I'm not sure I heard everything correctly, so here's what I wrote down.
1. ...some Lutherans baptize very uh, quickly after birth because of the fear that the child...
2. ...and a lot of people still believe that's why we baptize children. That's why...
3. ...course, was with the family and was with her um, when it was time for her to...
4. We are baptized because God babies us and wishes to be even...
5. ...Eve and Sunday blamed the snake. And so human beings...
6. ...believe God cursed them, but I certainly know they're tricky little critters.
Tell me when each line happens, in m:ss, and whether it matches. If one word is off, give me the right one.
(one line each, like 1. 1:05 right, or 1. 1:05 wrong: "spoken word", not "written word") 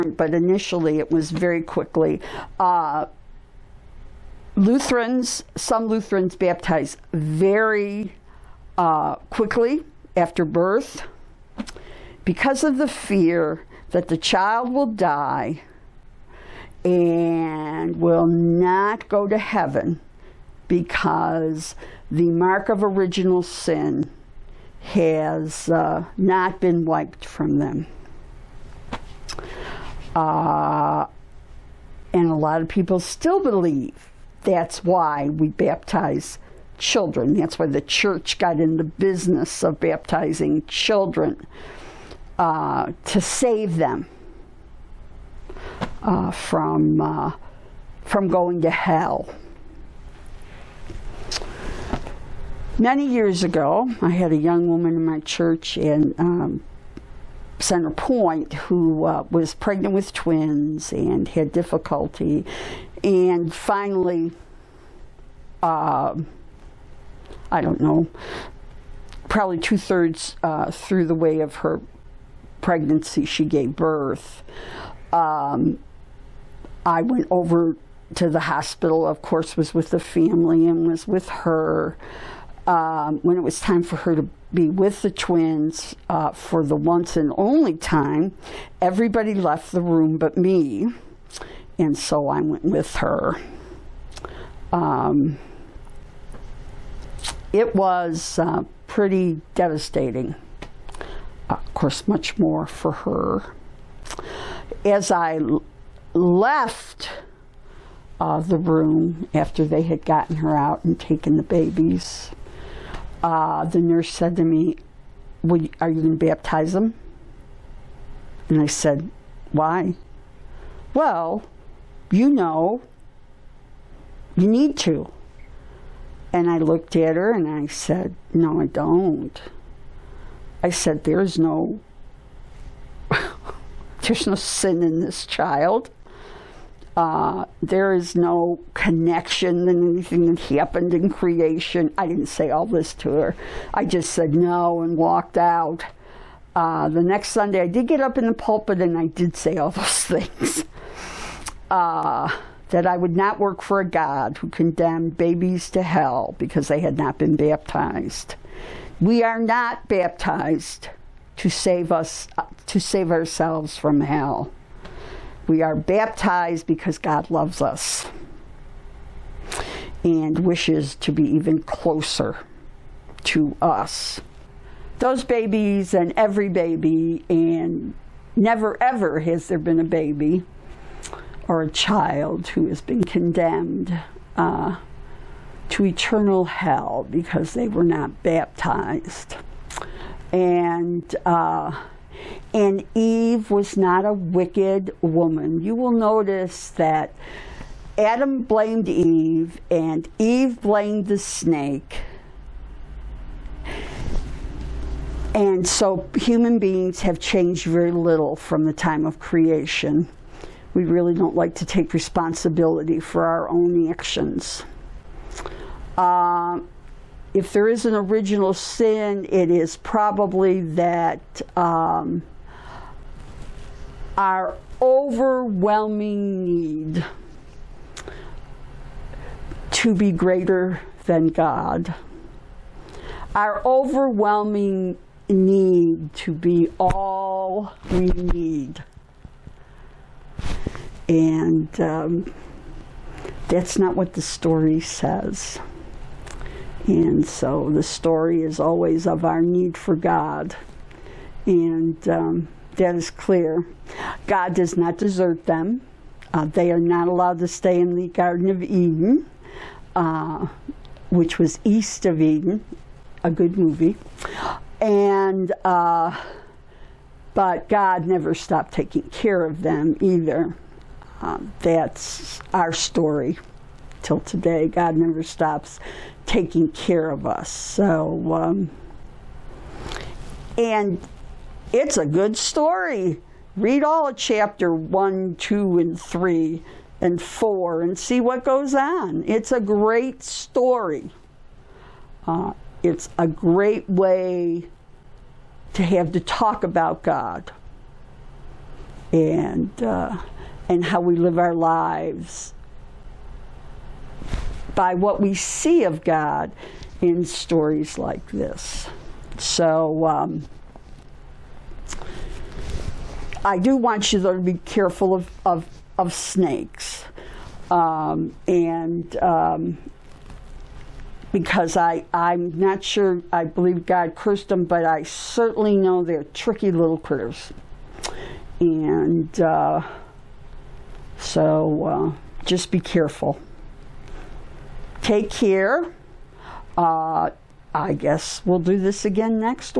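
1. 0:05 right
2. 0:32 right
3. 1:19 right
4. 2:45 wrong: "loves", not "babies"
5. 3:18 wrong: "Eve", not "Sunday"
6. 5:23 right.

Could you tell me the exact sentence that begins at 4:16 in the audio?
Uh, they are not allowed to stay in the Garden of Eden, uh, which was east of Eden, a good movie.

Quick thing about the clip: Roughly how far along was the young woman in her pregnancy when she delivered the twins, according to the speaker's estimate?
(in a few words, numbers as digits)
two thirds.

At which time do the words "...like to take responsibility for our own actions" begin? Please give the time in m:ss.
3:31.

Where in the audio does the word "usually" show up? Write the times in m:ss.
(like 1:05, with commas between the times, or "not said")
not said.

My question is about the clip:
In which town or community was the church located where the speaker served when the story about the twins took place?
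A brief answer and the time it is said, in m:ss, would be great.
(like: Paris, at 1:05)
Center Point, at 0:57.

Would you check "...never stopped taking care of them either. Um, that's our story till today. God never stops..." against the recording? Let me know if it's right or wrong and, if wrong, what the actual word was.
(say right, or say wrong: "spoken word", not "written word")
right.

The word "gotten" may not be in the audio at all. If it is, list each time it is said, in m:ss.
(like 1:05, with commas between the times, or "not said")
1:50.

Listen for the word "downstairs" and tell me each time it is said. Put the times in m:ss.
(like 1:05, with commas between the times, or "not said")
not said.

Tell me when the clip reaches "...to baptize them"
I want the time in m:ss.
1:56.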